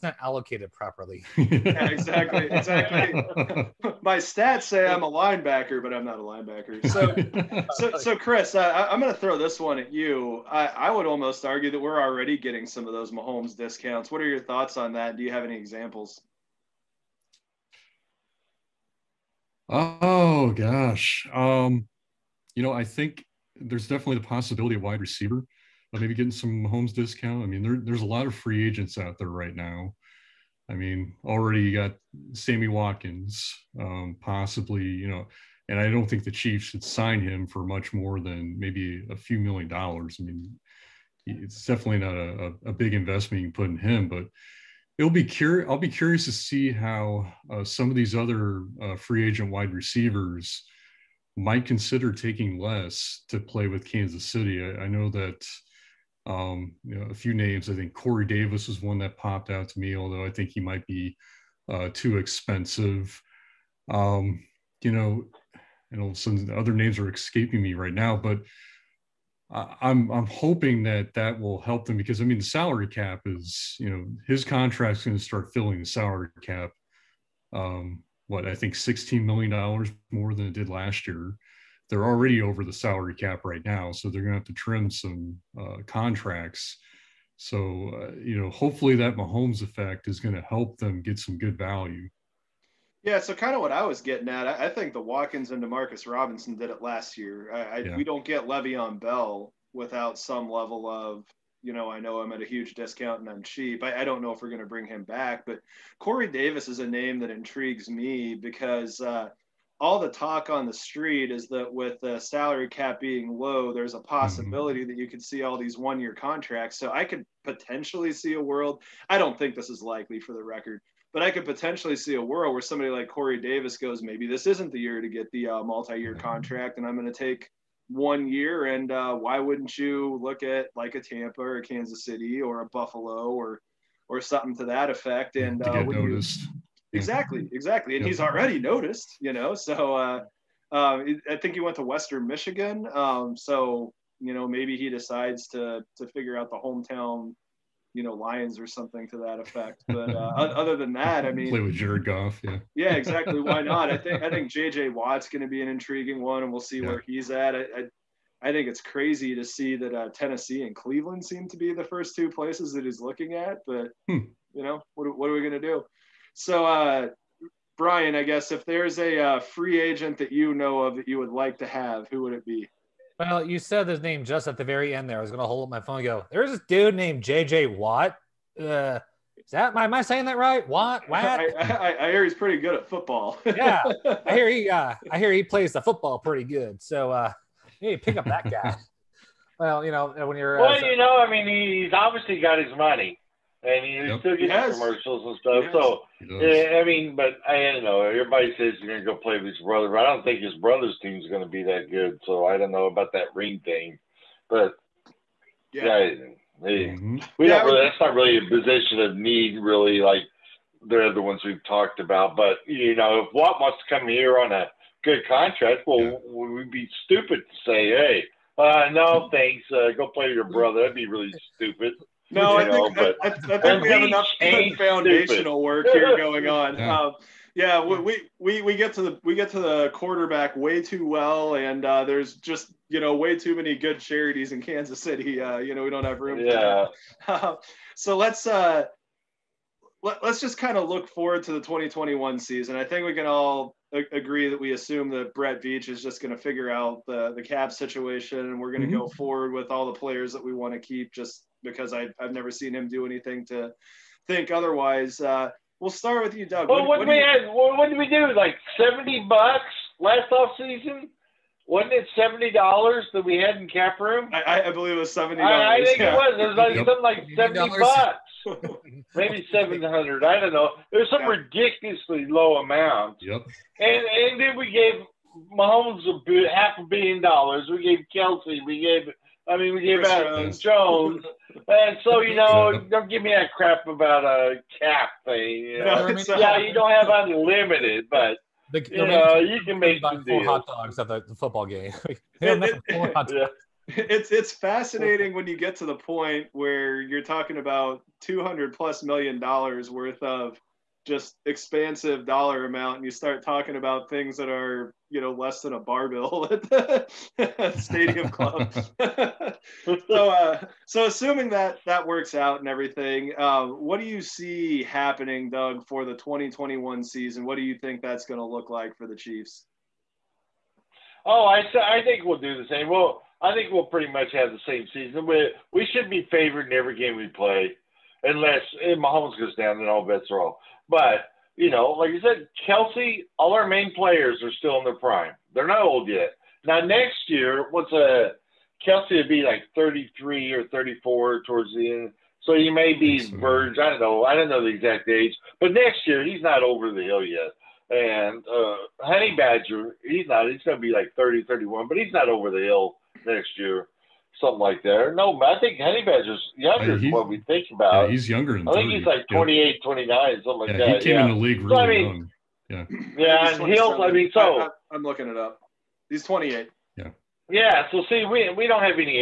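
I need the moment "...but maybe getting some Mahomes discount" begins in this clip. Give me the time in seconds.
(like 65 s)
25 s.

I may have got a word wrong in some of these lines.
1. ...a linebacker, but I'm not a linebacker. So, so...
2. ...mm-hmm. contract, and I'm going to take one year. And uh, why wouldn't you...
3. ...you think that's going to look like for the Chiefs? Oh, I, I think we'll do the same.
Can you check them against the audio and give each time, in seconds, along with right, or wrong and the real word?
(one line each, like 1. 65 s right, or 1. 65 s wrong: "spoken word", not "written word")
1. 5 s right
2. 126 s right
3. 317 s right.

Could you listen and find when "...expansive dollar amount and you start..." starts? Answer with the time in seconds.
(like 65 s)
301 s.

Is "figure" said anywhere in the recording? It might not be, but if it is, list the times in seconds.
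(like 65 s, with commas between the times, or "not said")
146 s, 246 s.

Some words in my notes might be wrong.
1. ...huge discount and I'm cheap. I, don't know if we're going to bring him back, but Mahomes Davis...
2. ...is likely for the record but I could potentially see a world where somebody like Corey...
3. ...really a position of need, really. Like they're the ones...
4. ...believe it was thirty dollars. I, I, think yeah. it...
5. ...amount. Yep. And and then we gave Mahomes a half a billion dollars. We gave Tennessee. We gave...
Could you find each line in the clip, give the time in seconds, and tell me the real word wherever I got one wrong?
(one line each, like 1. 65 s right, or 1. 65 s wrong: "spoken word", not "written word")
1. 102 s wrong: "Corey", not "Mahomes"
2. 119 s right
3. 208 s right
4. 264 s wrong: "seventy", not "thirty"
5. 272 s wrong: "Kelce", not "Tennessee".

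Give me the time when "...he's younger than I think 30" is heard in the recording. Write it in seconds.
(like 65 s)
358 s.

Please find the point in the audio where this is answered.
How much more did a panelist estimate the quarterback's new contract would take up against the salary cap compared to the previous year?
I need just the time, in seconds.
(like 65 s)
78 s.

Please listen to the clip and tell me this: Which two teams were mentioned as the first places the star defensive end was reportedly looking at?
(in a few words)
Tennessee and Cleveland.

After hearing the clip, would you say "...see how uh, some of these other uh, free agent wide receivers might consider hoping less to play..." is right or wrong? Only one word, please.
wrong.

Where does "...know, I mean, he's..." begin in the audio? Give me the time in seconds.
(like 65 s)
190 s.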